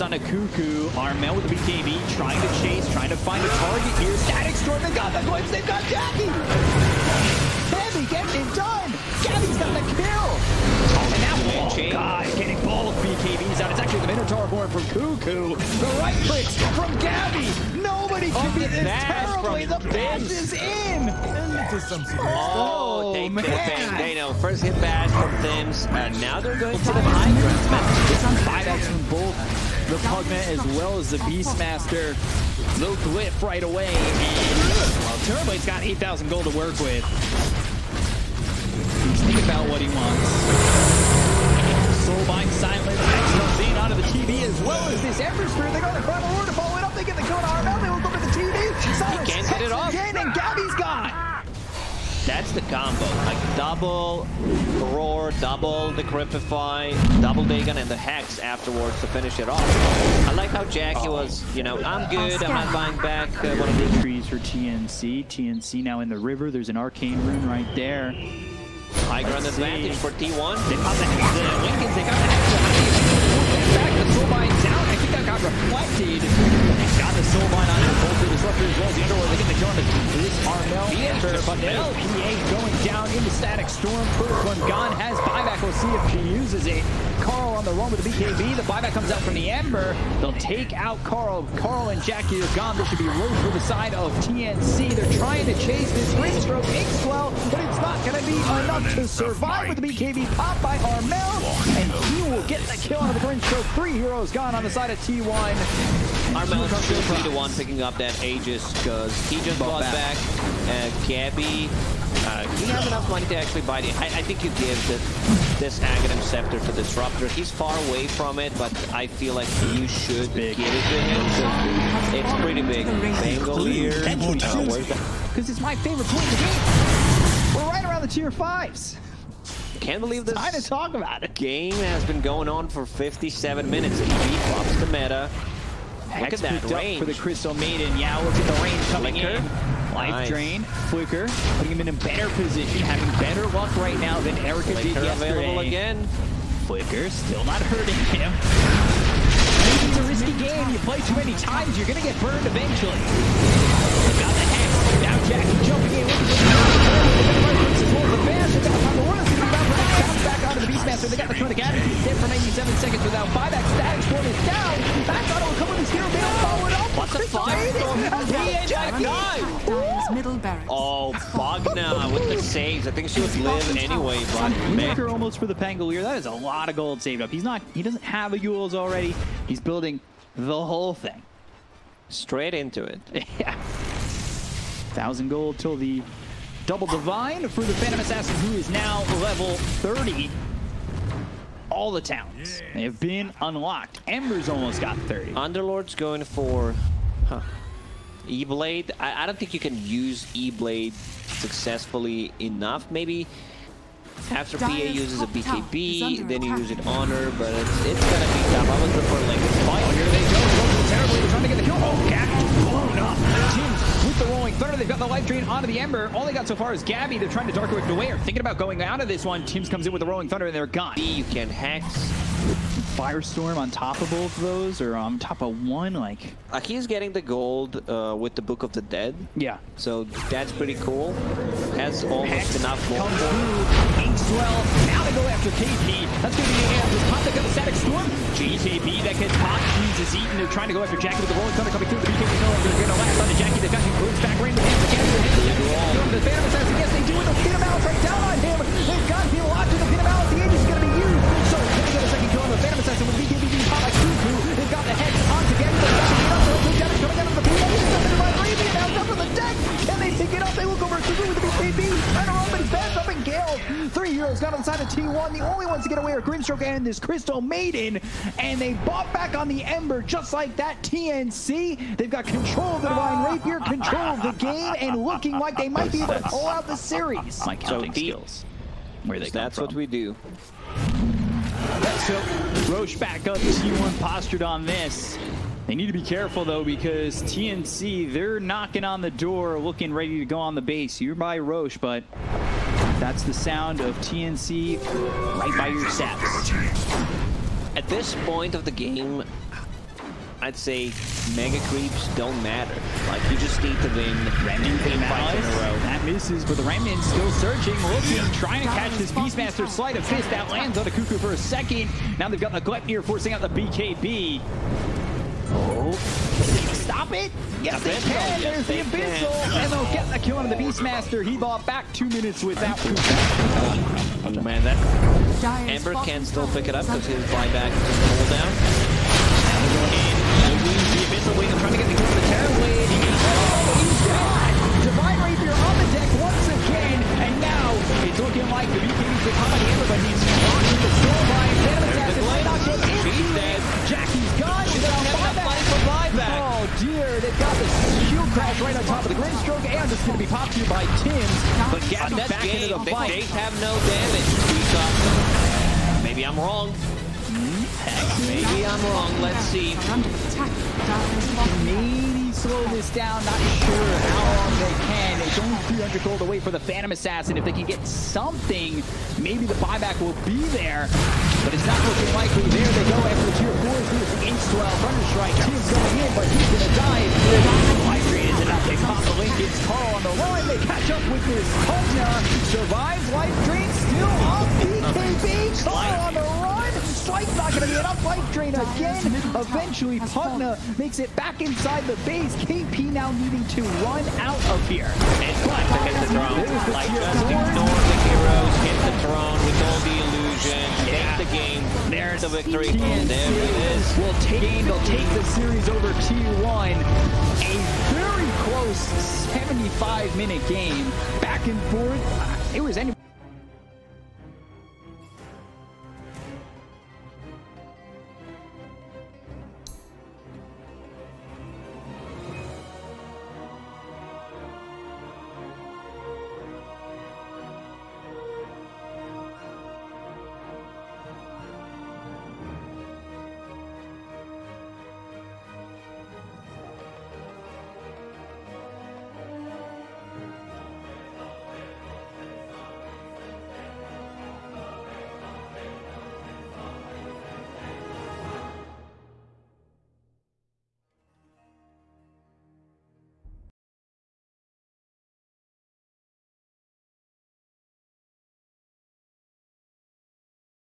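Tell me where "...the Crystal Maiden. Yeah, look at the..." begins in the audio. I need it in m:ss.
2:17.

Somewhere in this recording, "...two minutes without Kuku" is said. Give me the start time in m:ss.
5:21.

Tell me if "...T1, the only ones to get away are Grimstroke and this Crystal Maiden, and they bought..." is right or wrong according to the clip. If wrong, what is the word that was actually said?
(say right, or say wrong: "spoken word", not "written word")
right.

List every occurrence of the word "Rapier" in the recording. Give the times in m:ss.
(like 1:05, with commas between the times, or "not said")
4:33, 5:35.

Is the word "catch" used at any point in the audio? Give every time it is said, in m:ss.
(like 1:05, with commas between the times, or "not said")
5:08, 6:20.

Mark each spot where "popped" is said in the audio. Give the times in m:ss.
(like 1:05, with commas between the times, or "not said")
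3:59, 5:50.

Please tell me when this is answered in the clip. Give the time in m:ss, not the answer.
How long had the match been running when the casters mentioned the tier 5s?
2:12.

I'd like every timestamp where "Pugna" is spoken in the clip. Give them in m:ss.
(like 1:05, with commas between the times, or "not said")
0:30, 2:51, 6:21, 6:29.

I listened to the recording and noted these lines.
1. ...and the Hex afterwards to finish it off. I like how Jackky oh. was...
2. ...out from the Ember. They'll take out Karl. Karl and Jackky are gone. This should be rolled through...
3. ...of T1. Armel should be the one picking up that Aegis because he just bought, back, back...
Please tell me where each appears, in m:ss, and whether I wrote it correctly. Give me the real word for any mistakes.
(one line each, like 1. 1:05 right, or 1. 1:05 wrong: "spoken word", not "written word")
1. 0:57 right
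2. 1:29 right
3. 1:44 right.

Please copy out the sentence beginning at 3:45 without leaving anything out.
Like, like he's getting the gold uh, with the Book of the Dead.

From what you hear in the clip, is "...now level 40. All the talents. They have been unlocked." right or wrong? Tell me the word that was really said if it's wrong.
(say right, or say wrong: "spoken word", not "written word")
wrong: "30", not "40".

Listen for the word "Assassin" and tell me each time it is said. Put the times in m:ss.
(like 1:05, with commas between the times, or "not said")
3:08, 4:06, 5:41, 6:06.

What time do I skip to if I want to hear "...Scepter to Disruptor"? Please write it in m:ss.
1:56.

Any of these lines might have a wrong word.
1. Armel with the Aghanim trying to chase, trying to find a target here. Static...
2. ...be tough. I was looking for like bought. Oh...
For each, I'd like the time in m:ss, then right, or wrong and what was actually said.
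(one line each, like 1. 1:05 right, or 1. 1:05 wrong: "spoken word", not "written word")
1. 0:00 wrong: "BKB", not "Aghanim"
2. 3:28 wrong: "fight", not "bought".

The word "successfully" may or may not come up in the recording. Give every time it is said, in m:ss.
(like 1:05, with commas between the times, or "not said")
3:20.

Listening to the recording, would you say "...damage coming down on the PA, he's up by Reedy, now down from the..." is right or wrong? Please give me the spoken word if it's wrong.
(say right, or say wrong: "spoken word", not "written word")
right.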